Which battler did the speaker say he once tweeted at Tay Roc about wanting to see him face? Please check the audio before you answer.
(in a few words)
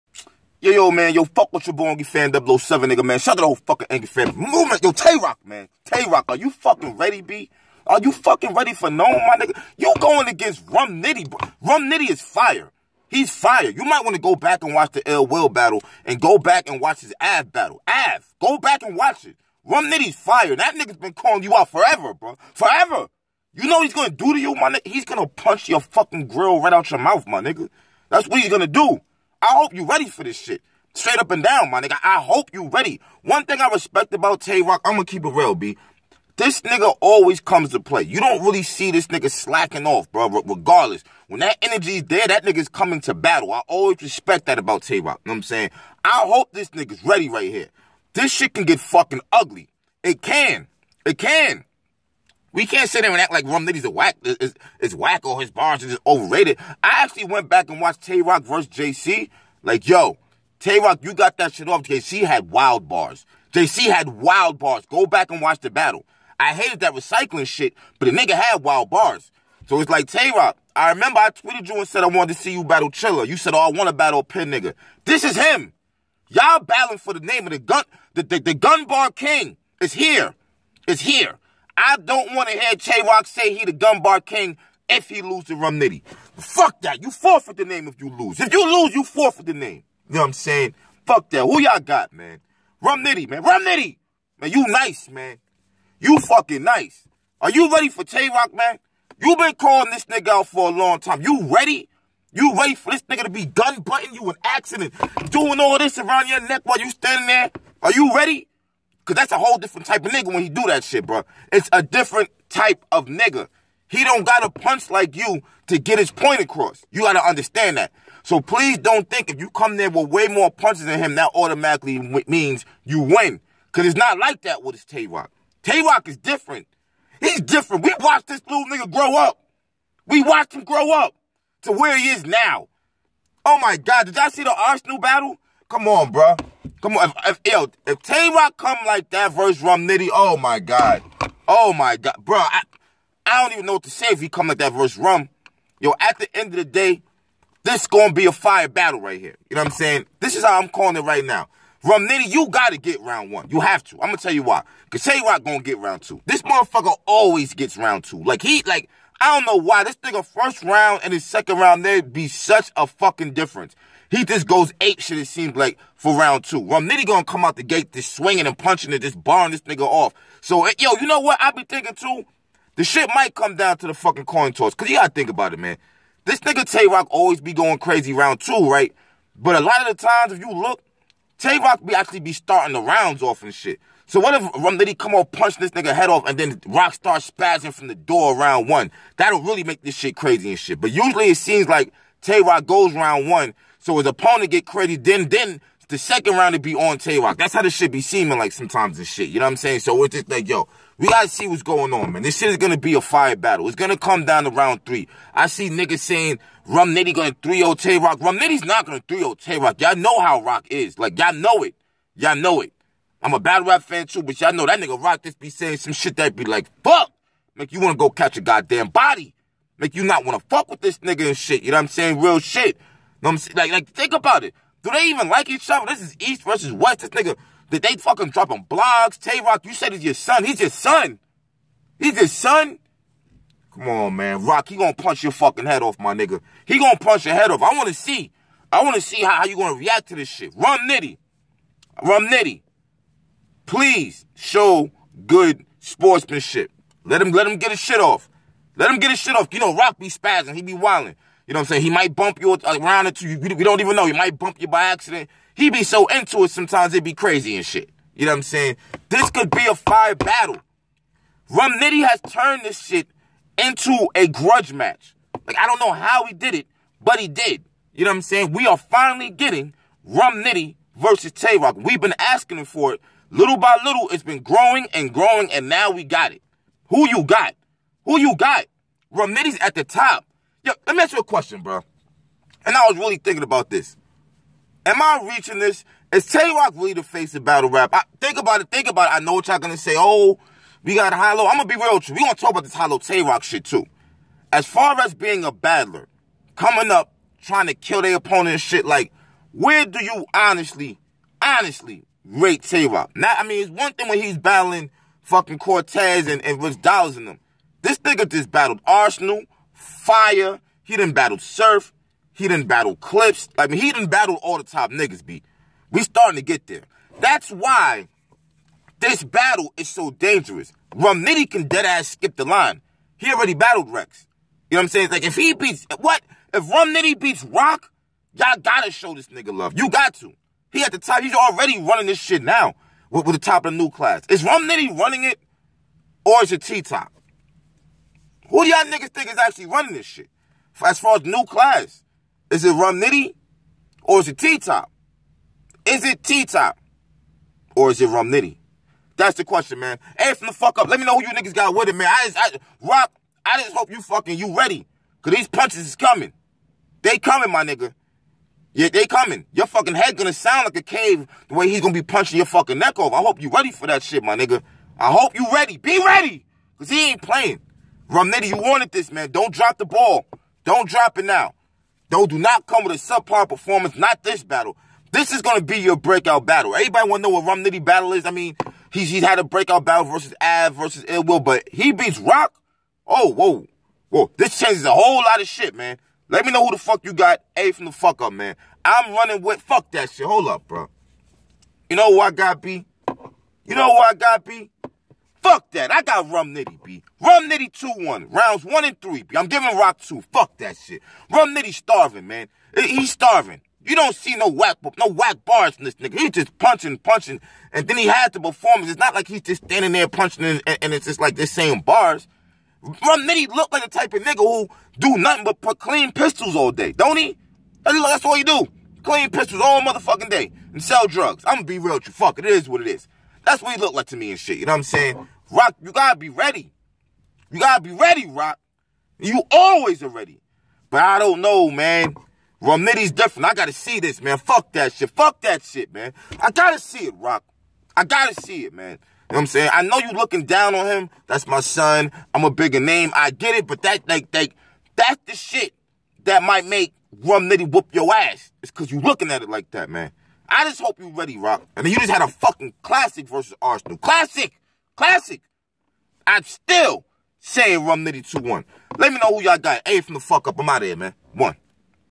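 Chiller.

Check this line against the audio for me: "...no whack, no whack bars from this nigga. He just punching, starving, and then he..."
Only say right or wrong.
wrong.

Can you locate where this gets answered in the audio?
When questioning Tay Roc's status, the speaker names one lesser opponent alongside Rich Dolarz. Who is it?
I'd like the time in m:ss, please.
5:05.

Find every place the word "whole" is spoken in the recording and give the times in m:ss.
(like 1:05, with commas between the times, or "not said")
0:03, 1:49, 6:24.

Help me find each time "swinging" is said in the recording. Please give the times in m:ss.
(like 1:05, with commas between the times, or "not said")
2:48.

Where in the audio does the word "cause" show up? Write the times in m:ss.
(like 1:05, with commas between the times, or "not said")
1:49, 2:03, 2:34, 2:54, 5:55, 6:06, 7:28.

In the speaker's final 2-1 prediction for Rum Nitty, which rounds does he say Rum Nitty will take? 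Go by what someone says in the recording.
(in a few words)
Rounds 1 and 3.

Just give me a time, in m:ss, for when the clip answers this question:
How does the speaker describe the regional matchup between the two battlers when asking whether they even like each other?
3:46.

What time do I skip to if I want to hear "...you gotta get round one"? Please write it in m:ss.
2:32.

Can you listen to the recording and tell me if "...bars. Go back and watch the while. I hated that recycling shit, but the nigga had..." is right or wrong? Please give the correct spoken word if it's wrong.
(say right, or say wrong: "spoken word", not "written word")
wrong: "battle", not "while".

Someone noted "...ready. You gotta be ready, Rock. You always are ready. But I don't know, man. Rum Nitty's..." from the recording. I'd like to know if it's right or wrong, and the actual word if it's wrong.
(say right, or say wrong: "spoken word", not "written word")
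right.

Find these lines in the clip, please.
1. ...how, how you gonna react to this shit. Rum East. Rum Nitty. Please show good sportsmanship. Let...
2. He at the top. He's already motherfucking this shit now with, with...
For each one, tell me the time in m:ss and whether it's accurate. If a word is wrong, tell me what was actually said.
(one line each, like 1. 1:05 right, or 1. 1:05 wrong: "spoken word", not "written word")
1. 3:59 wrong: "Nitty", not "East"
2. 5:30 wrong: "running", not "motherfucking".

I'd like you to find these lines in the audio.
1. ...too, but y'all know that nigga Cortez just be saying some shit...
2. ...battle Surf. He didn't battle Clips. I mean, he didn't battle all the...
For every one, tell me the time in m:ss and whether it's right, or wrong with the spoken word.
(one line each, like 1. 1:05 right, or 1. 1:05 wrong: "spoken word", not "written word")
1. 3:34 wrong: "Rock", not "Cortez"
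2. 5:11 right.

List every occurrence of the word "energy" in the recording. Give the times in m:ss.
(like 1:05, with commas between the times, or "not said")
0:41.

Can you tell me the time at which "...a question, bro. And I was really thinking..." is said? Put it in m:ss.
4:41.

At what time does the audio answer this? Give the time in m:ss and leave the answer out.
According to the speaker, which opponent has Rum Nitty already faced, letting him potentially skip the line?
5:23.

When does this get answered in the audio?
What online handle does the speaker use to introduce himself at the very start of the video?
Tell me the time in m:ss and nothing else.
0:01.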